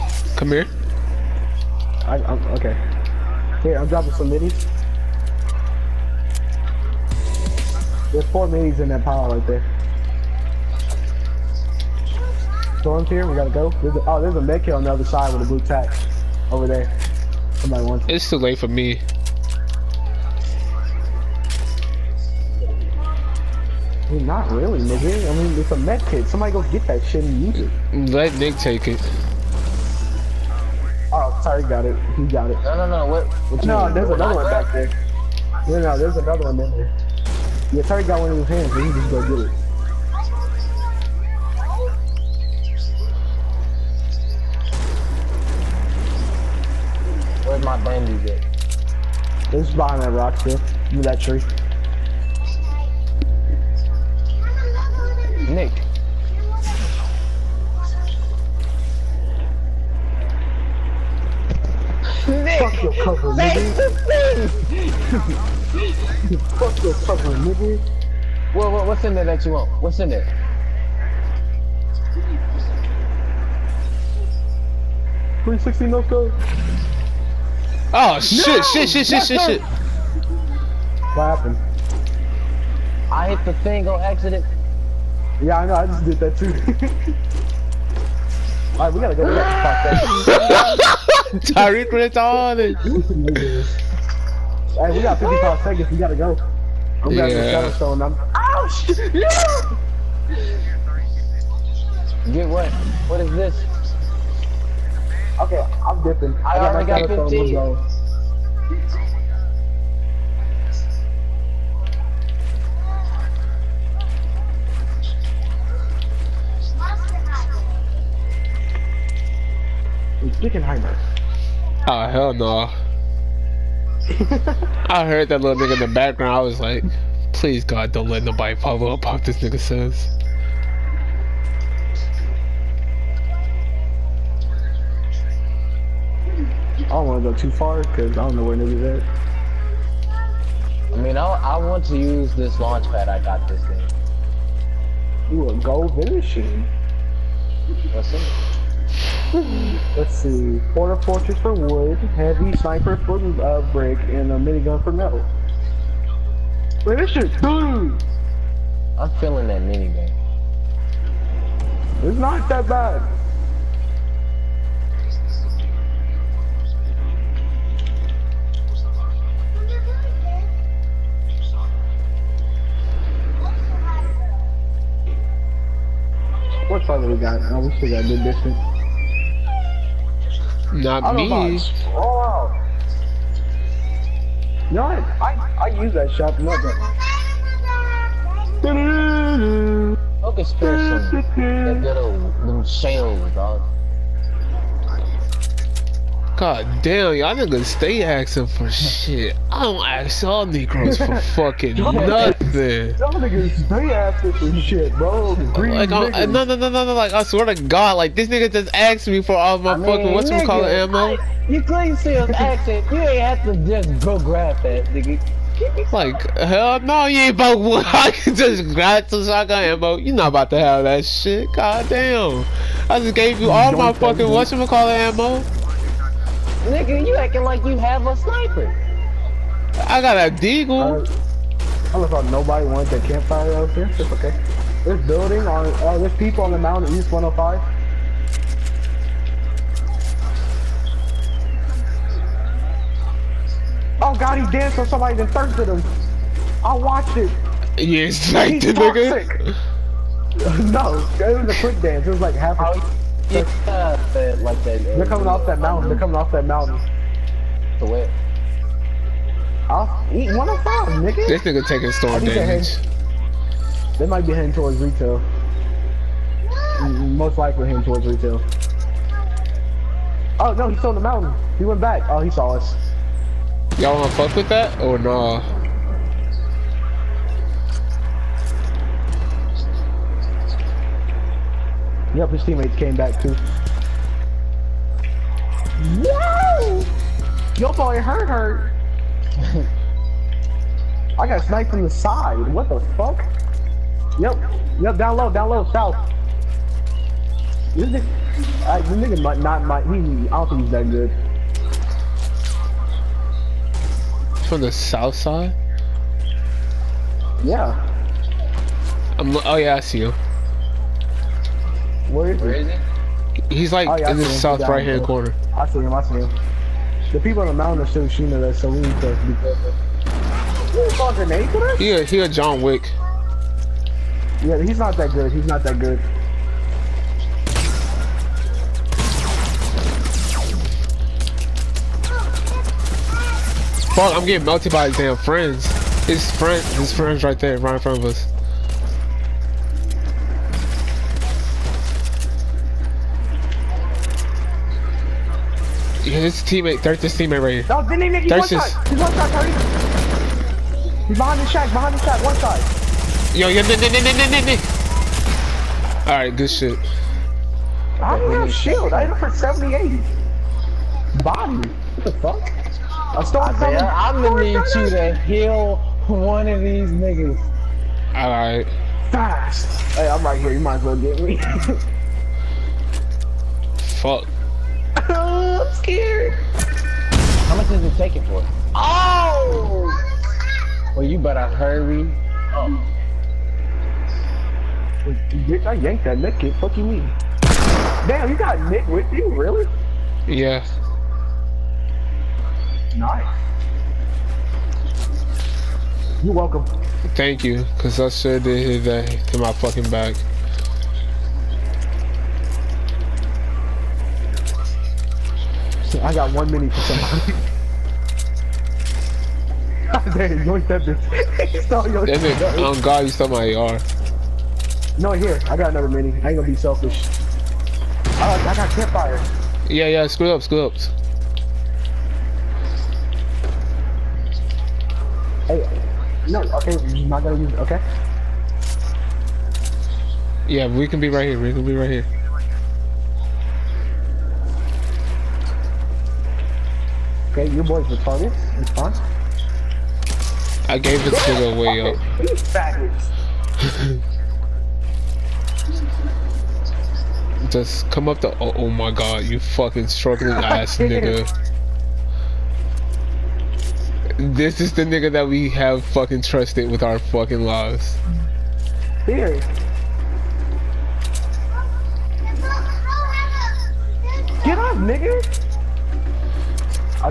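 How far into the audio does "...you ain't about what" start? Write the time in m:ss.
3:37.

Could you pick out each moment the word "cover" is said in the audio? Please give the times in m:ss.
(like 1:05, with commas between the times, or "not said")
1:03.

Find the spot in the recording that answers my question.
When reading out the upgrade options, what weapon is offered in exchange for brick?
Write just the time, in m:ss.
2:31.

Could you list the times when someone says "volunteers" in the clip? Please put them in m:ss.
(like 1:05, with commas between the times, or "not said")
not said.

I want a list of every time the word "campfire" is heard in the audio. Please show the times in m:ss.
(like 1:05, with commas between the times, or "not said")
3:53, 6:58.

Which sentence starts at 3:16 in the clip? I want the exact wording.
God damn, y'all niggas stay asking for shit.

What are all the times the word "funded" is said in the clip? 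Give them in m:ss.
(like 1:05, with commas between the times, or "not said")
not said.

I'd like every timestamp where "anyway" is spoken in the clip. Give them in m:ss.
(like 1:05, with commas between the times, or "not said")
not said.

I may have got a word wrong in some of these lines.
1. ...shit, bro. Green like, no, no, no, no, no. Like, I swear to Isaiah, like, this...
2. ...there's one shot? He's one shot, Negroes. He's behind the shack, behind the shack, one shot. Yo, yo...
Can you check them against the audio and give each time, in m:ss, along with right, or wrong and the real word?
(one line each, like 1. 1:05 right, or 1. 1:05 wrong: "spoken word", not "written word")
1. 3:24 wrong: "God", not "Isaiah"
2. 5:48 wrong: "Curry", not "Negroes".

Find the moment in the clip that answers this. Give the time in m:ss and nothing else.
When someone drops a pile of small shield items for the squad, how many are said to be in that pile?
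0:08.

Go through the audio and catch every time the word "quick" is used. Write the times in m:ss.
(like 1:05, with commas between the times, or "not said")
4:11.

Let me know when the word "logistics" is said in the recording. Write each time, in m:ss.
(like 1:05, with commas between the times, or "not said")
not said.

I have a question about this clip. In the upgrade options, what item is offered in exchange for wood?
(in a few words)
Port-a-Fortress.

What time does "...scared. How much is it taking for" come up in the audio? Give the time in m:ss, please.
6:15.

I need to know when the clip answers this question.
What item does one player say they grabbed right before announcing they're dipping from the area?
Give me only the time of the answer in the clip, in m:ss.
1:37.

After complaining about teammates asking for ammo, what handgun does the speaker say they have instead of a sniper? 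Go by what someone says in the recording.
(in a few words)
deagle.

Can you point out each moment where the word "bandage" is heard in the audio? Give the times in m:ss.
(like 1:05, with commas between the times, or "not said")
0:47.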